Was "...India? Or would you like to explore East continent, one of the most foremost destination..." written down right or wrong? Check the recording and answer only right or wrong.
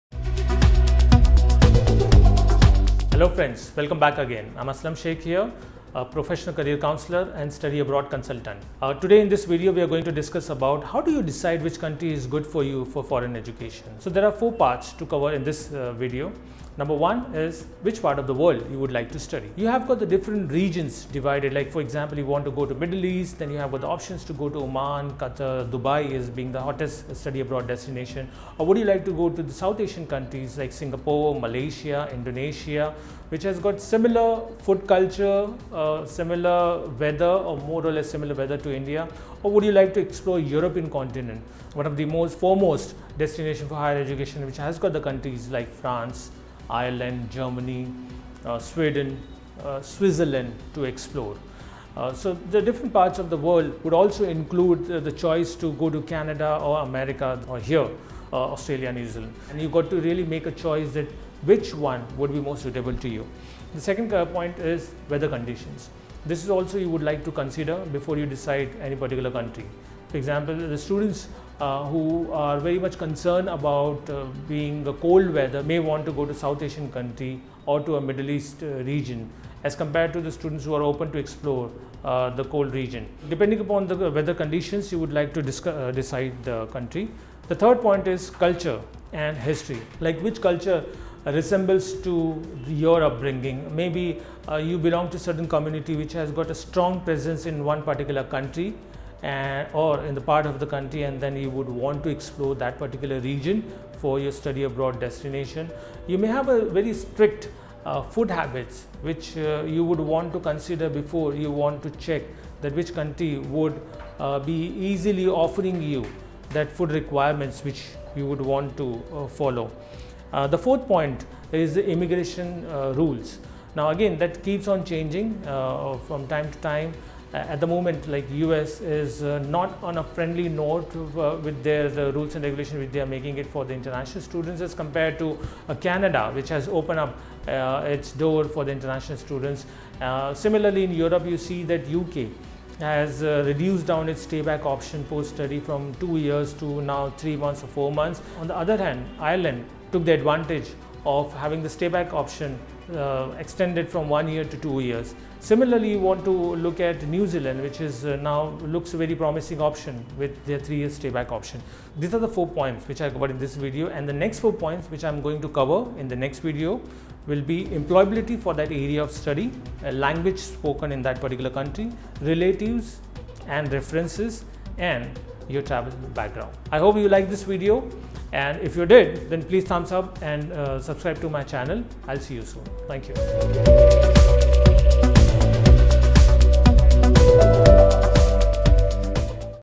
wrong.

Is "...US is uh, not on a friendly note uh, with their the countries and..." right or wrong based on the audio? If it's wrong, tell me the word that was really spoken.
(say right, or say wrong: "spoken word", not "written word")
wrong: "rules", not "countries".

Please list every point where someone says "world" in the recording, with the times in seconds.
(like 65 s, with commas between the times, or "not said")
18 s, 53 s.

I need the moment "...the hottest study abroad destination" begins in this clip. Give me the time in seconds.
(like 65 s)
26 s.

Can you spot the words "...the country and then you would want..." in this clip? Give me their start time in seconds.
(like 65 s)
100 s.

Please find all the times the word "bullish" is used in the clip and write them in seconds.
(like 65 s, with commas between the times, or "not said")
not said.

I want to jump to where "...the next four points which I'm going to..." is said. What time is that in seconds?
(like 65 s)
164 s.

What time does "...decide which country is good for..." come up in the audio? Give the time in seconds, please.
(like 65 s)
11 s.